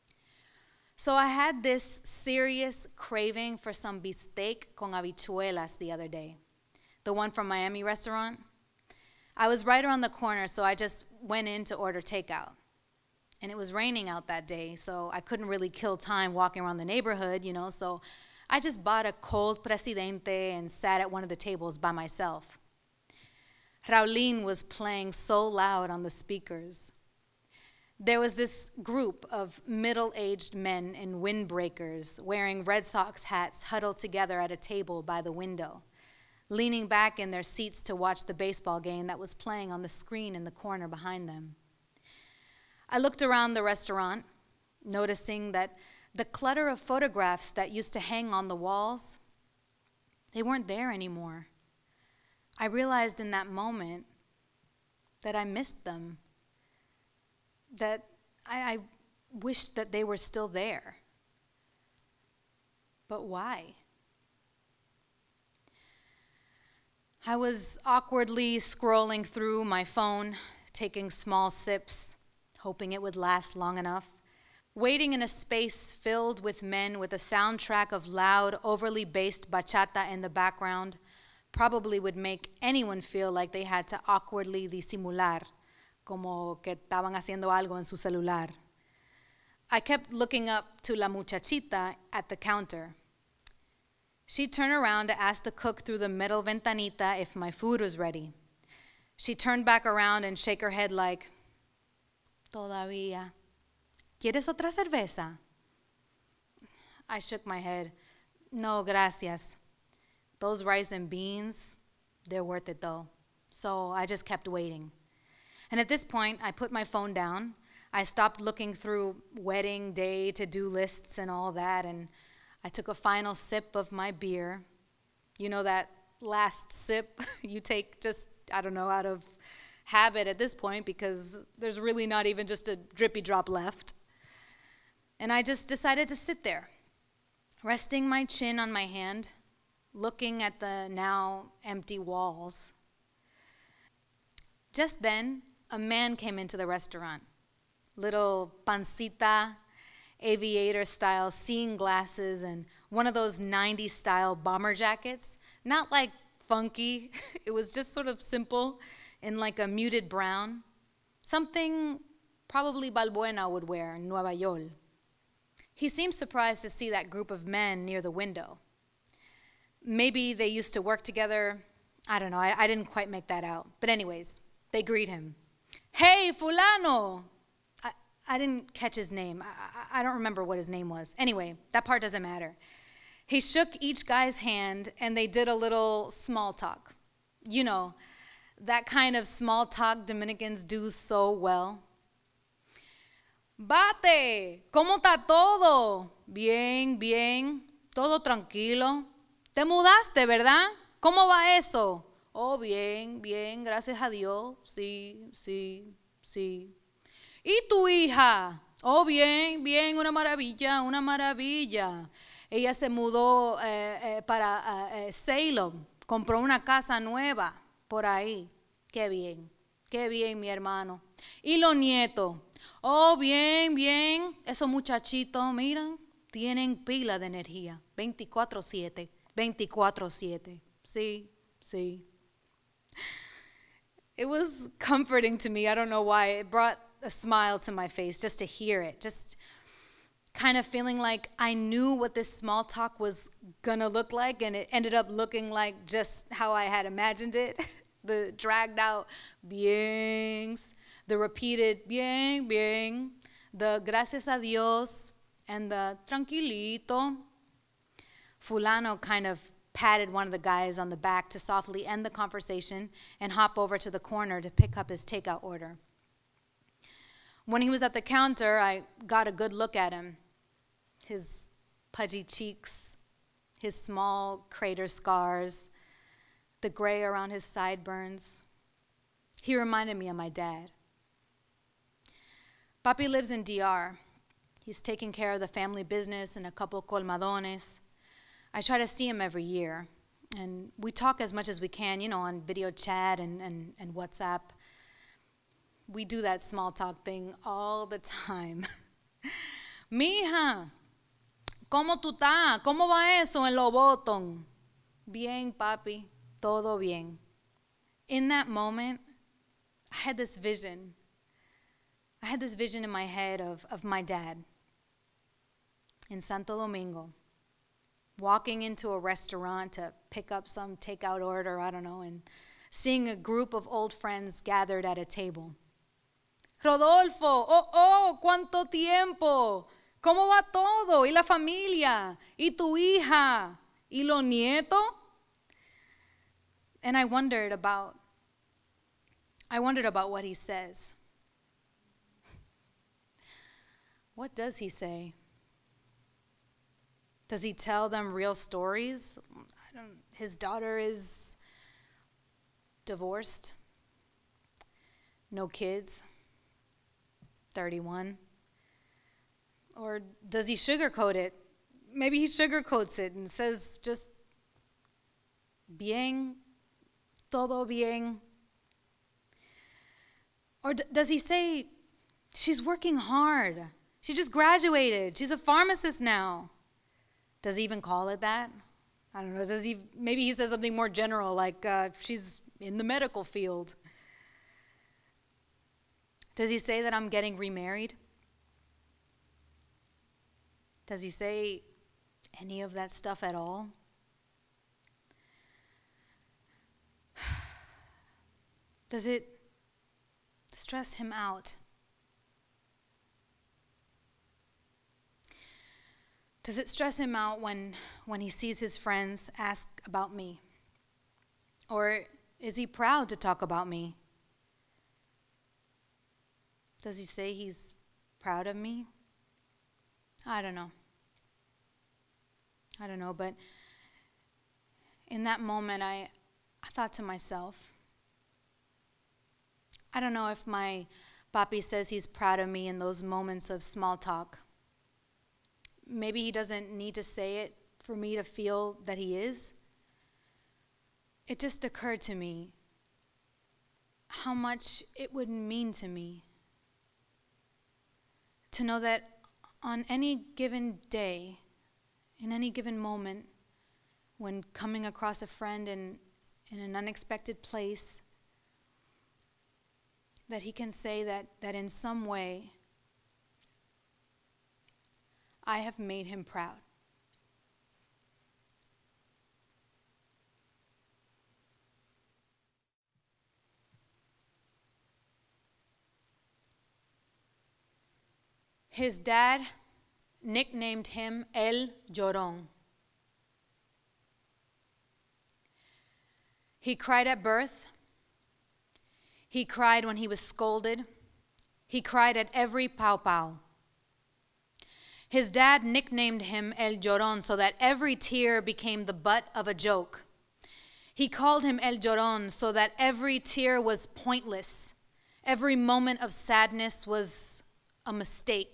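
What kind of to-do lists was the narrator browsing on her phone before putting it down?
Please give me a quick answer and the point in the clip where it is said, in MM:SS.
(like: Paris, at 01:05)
Wedding day to do lists, at 01:59.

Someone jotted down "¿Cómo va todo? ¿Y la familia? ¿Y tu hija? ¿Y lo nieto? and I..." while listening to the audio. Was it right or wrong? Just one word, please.
right.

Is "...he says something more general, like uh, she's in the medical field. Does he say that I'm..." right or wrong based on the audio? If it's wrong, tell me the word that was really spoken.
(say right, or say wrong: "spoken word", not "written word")
right.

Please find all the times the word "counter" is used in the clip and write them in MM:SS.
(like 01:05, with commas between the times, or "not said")
01:32, 04:28.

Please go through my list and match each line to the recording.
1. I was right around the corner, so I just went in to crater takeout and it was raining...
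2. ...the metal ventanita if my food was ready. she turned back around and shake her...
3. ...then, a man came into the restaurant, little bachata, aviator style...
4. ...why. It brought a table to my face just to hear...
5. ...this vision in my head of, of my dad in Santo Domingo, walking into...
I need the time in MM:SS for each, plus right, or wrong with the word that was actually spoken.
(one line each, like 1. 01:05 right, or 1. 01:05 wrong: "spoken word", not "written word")
1. 00:09 wrong: "order", not "crater"
2. 01:35 right
3. 02:25 wrong: "pancita", not "bachata"
4. 03:56 wrong: "smile", not "table"
5. 05:12 right.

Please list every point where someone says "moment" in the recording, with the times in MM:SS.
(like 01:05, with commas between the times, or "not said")
00:53, 05:08, 07:05, 07:13, 07:32, 08:25.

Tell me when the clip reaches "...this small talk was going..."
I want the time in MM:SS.
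04:02.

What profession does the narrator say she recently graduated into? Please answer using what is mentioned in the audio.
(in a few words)
Pharmacist.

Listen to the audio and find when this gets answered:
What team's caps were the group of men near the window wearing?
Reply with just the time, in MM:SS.
00:32.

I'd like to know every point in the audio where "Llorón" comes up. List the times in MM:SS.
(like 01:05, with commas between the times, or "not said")
08:01, 08:16, 08:21.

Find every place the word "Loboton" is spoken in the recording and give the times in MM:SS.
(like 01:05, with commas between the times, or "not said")
05:03.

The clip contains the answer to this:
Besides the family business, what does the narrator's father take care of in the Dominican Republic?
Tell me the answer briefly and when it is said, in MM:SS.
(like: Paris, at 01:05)
A couple colmadones, at 04:46.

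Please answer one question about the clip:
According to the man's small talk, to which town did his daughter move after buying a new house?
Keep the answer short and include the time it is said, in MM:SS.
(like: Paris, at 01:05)
Salem, at 03:35.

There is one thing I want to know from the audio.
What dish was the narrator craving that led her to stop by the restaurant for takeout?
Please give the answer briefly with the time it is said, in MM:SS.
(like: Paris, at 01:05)
Bistec con habichuelas, at 00:03.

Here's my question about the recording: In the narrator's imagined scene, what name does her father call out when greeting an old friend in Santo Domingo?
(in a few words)
Rodolfo.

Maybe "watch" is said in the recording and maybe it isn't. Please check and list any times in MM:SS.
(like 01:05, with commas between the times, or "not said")
00:37.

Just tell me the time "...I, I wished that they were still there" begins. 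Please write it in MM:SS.
00:58.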